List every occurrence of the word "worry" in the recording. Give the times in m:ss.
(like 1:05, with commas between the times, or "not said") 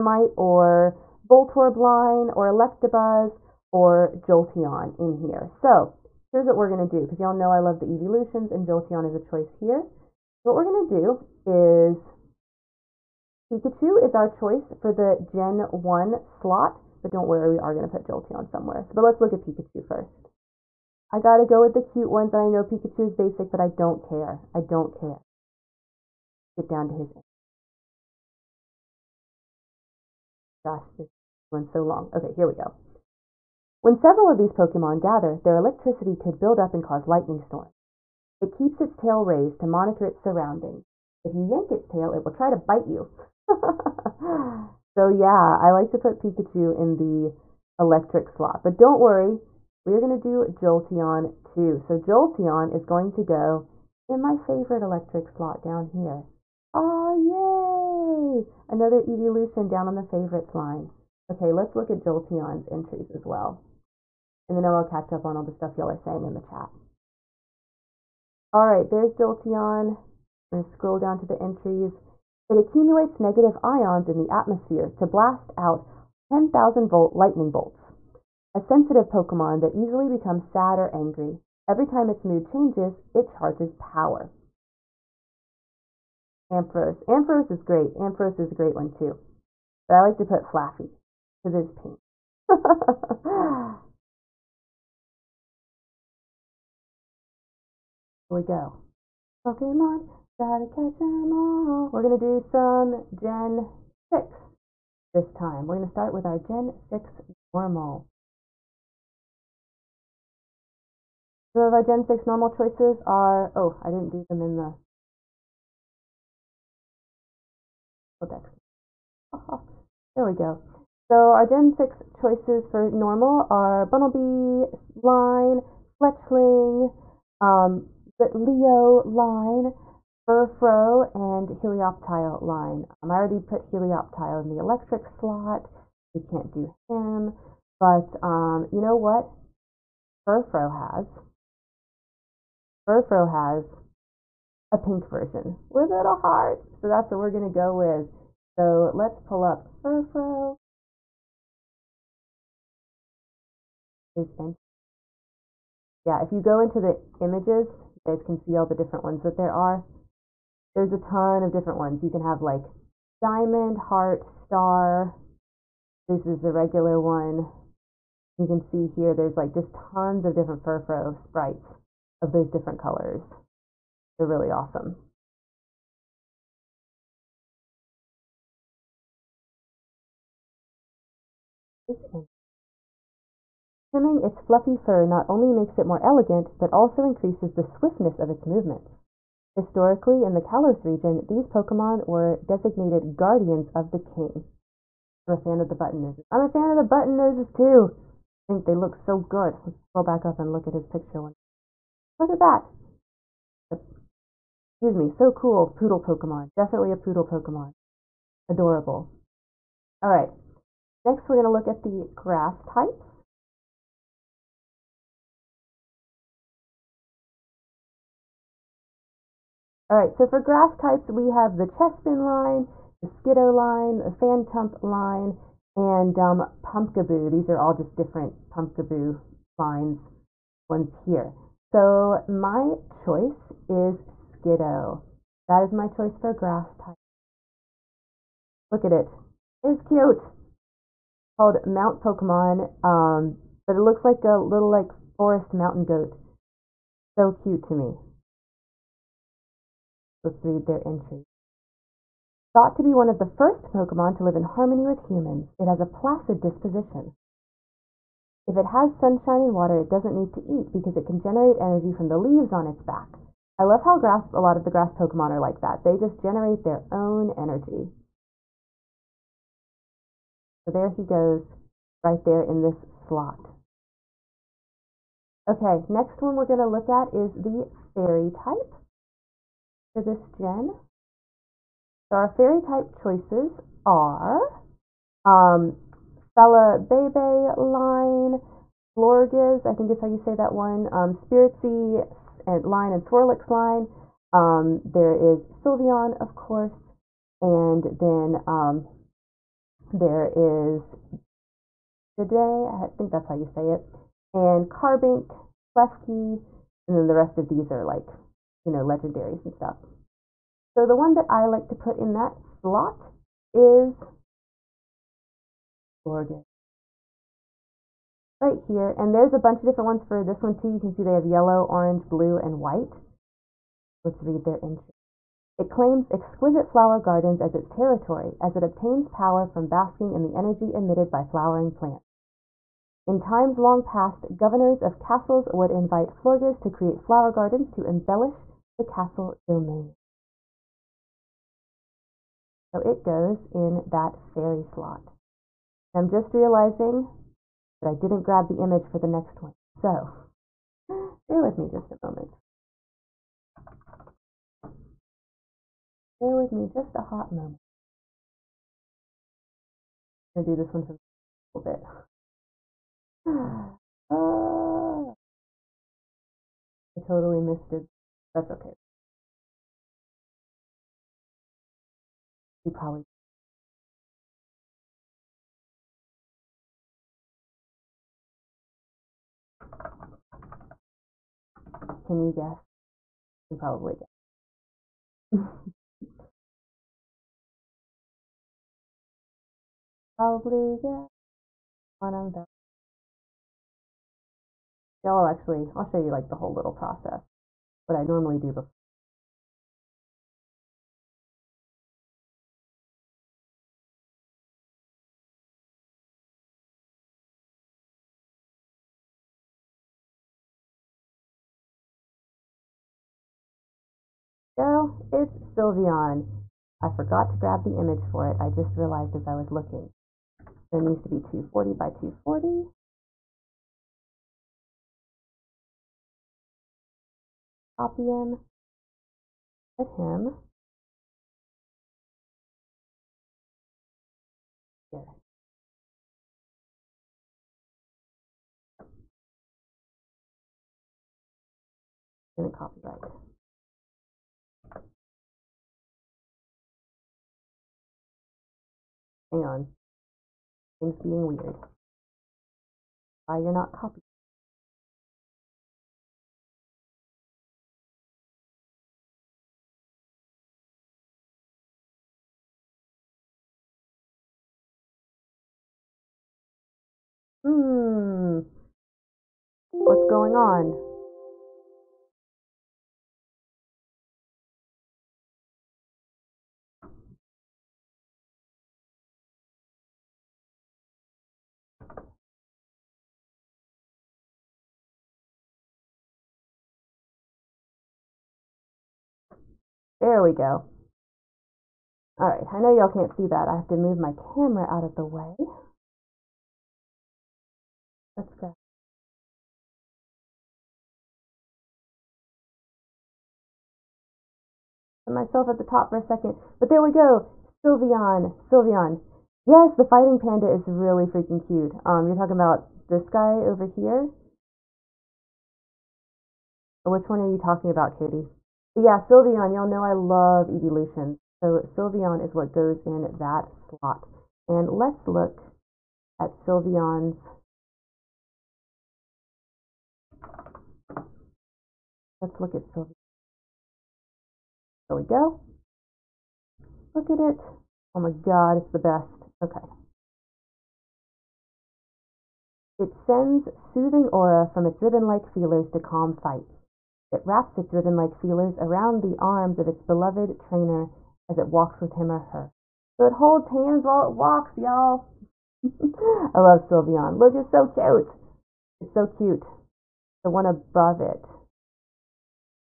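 0:17, 0:49.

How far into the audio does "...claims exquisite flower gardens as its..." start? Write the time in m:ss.
5:25.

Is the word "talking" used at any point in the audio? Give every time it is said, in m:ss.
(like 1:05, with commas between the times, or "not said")
8:32, 8:37.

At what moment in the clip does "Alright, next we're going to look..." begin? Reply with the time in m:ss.
3:30.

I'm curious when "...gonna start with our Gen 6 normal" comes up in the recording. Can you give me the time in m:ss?
1:45.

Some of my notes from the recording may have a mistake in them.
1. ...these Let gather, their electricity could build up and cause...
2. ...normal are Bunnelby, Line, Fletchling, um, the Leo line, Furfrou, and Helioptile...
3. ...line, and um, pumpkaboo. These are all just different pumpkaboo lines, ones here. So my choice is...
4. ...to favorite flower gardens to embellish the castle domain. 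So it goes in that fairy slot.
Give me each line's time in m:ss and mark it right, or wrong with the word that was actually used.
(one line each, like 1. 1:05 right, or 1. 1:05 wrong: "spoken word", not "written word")
1. 0:34 wrong: "Pokemon", not "Let"
2. 2:02 right
3. 3:44 right
4. 5:36 wrong: "create", not "favorite".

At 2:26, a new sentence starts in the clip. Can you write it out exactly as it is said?
So that's what we're going to go with.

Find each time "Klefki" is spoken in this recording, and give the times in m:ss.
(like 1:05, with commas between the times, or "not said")
5:05.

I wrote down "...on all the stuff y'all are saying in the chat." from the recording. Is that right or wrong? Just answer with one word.
right.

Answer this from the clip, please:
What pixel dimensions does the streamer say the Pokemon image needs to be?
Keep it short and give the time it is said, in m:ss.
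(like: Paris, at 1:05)
240 by 240, at 7:01.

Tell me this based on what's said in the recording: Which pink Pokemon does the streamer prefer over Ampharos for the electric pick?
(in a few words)
Flaaffy.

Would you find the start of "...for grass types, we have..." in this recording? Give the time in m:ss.
3:40.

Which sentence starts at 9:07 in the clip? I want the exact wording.
It wraps its ribbon-like feelers around the arms of its beloved trainer as it walks with him or her.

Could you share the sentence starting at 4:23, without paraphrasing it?
I love how grass, a lot of the grass Pokemon are like that.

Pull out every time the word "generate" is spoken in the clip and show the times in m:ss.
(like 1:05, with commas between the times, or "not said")
4:21, 4:26.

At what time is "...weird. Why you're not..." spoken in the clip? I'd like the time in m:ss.
7:31.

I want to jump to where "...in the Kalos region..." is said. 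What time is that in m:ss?
3:10.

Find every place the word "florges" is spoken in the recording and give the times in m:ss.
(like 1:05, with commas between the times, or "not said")
4:48, 5:16, 5:36.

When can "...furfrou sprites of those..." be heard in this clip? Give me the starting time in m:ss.
2:50.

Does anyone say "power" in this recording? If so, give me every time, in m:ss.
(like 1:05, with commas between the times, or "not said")
1:23, 5:29.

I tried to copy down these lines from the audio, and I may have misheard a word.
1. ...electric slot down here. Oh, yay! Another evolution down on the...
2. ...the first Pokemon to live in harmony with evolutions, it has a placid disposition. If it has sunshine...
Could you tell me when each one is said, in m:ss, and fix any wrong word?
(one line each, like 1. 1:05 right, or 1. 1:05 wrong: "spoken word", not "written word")
1. 0:54 right
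2. 4:13 wrong: "humans", not "evolutions".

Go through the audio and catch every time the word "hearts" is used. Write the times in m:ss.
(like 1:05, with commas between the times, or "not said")
2:26, 2:43.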